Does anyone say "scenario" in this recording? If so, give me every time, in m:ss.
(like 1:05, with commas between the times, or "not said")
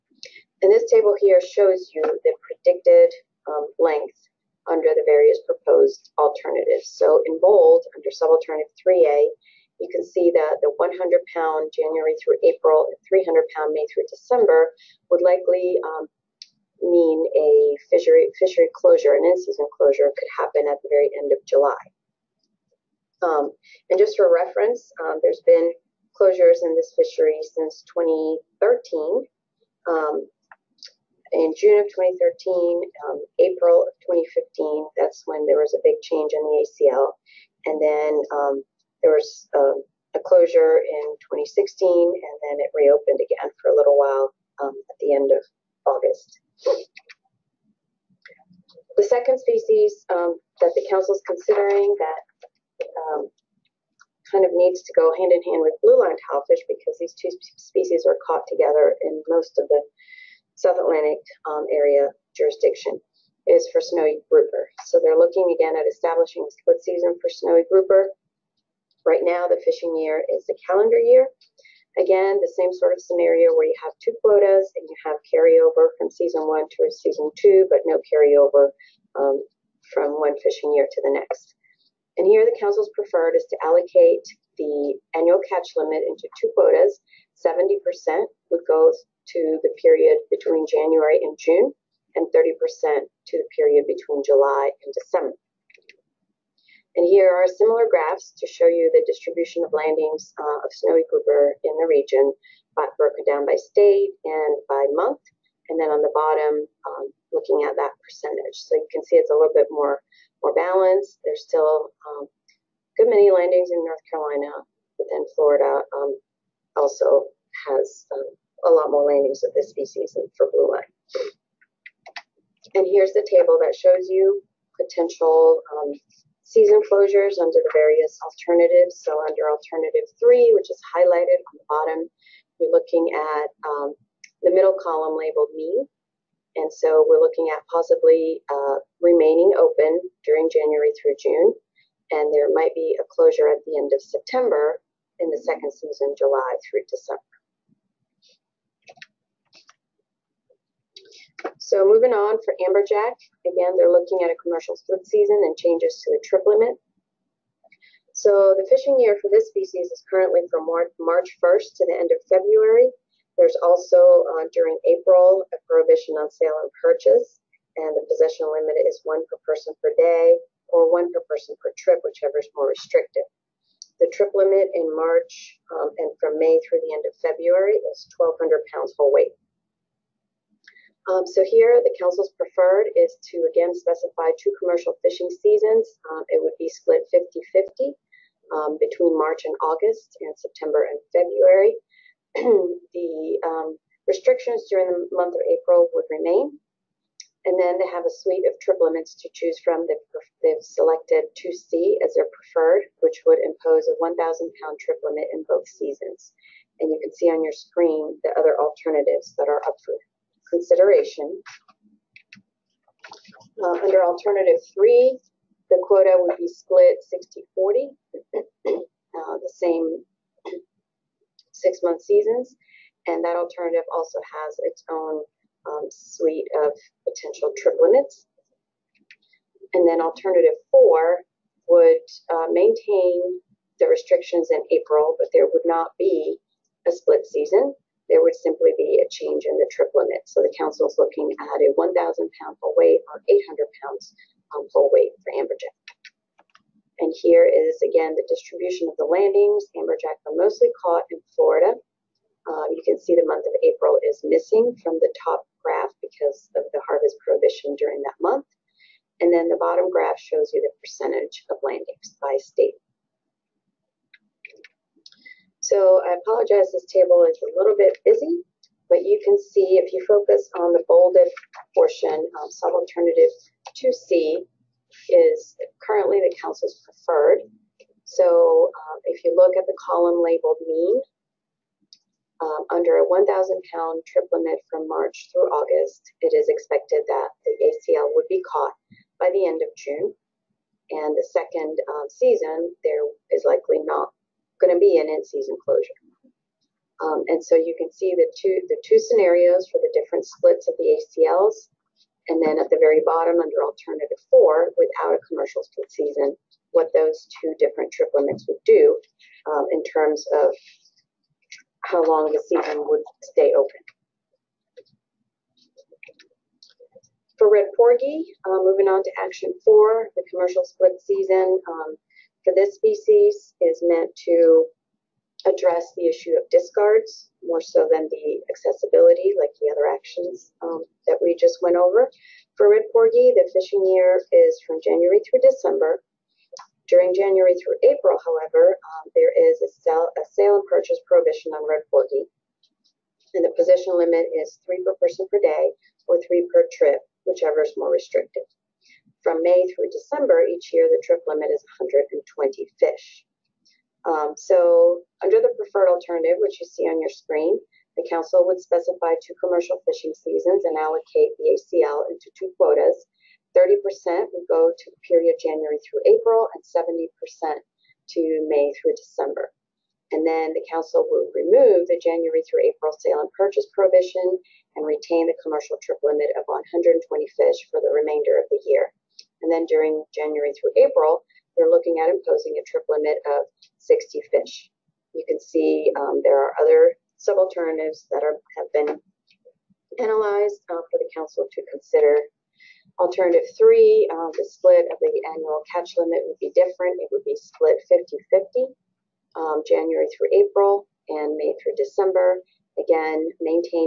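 1:12, 4:58.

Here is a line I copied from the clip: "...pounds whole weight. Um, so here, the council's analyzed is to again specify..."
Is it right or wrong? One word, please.
wrong.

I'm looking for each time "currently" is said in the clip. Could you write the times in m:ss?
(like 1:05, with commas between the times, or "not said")
2:40, 4:35.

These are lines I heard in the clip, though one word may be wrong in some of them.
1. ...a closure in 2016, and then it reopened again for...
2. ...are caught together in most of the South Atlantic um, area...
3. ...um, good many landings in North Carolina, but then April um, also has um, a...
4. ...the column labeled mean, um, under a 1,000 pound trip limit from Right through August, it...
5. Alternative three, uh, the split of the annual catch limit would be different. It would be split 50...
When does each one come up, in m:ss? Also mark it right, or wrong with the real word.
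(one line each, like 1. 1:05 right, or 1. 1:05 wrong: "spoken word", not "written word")
1. 0:40 right
2. 0:58 right
3. 1:52 wrong: "Florida", not "April"
4. 4:39 wrong: "March", not "Right"
5. 6:32 right.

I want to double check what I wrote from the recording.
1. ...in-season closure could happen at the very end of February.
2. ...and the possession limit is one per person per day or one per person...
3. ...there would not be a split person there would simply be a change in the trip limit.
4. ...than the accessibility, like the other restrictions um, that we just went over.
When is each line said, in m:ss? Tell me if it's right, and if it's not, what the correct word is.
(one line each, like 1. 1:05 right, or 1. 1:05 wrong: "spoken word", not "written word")
1. 0:19 wrong: "July", not "February"
2. 2:47 right
3. 3:55 wrong: "season", not "person"
4. 5:27 wrong: "actions", not "restrictions".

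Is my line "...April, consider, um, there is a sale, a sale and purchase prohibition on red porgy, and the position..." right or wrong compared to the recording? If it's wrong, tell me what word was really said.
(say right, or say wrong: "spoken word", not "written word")
wrong: "however", not "consider".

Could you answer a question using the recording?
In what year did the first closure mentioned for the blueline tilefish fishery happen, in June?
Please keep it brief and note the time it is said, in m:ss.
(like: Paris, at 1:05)
2013, at 0:31.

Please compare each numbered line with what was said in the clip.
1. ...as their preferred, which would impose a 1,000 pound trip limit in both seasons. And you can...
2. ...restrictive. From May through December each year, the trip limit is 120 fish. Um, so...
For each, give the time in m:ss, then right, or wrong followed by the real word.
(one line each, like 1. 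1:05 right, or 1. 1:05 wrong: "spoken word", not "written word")
1. 3:22 right
2. 5:47 right.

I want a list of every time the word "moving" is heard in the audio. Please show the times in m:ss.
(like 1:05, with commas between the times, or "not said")
2:31, 5:18.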